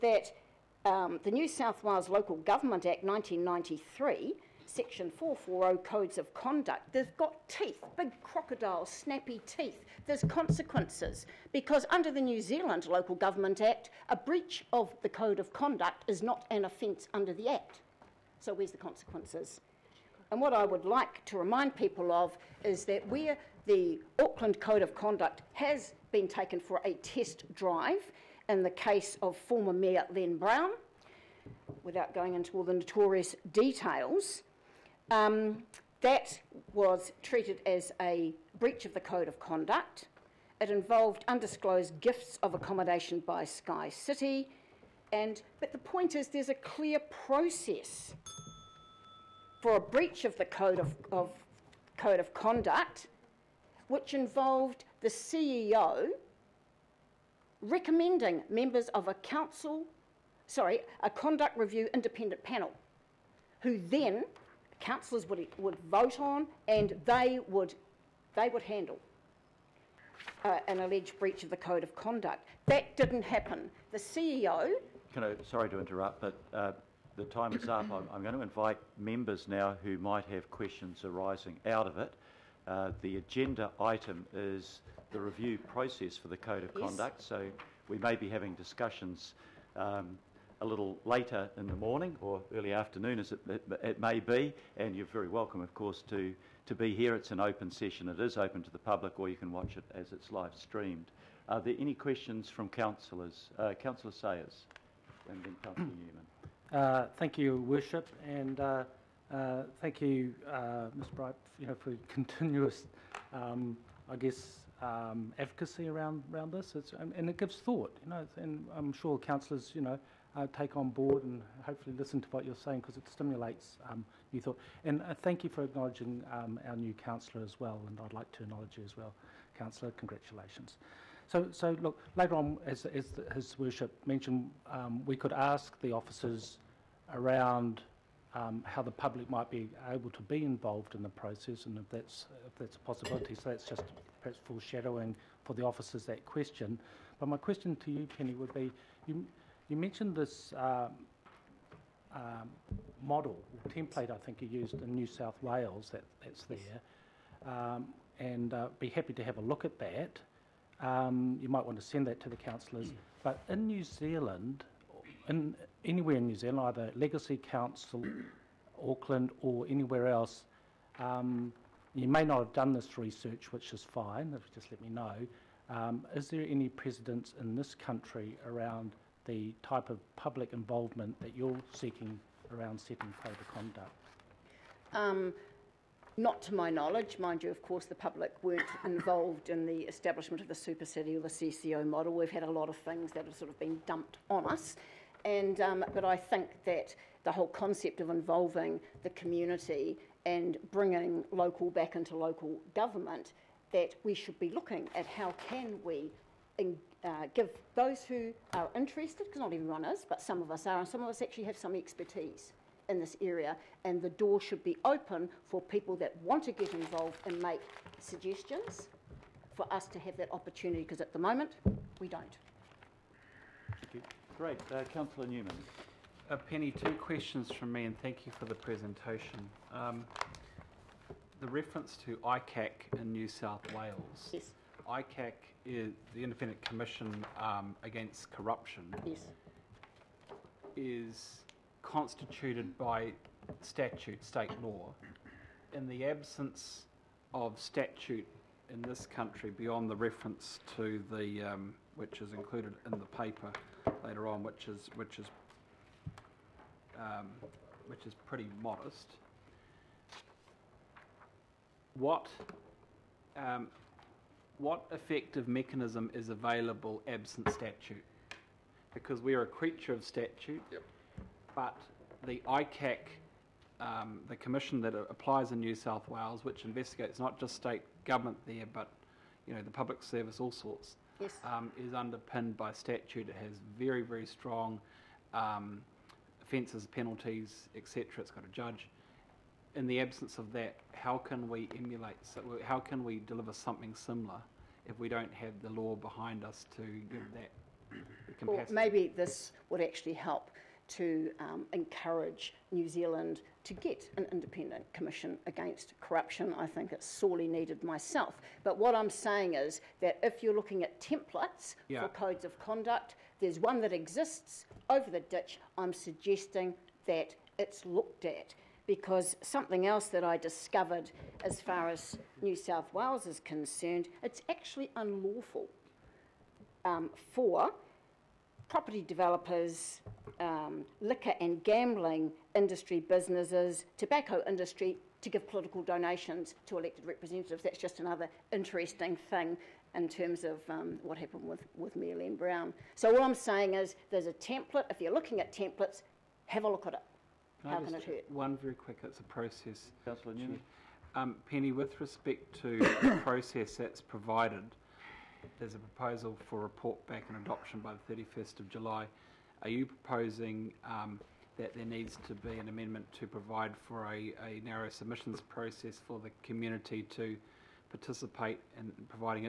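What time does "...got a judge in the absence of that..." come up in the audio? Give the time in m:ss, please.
4:48.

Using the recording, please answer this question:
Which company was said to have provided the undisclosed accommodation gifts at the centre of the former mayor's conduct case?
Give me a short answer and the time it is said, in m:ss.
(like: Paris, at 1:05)
SkyCity, at 0:43.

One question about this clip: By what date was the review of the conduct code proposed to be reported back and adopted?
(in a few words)
31 July.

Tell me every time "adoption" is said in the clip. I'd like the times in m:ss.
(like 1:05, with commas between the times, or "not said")
5:57.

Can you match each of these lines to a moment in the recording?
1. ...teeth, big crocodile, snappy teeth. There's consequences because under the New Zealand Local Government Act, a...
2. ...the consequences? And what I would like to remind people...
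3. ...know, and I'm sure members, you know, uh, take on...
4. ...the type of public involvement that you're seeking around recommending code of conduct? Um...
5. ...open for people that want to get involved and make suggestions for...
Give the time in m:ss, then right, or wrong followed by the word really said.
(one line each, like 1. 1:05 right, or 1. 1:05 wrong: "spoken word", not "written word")
1. 0:07 right
2. 0:18 right
3. 1:58 wrong: "councillors", not "members"
4. 2:59 wrong: "setting", not "recommending"
5. 3:34 right.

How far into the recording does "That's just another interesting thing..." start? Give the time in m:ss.
5:37.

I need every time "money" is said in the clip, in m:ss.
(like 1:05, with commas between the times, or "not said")
not said.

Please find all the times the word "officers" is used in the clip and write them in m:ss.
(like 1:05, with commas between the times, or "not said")
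2:15, 2:25.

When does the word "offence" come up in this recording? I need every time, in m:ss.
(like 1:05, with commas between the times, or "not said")
0:16, 4:46.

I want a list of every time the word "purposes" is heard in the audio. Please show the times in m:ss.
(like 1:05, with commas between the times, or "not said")
not said.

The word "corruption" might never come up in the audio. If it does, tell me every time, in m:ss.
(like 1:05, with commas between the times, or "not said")
3:58, 5:06.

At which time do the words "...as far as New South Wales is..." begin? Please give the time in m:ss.
5:21.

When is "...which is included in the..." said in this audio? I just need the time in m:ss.
4:11.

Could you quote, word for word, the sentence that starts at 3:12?
We've had a lot of things that have sort of been dumped on us.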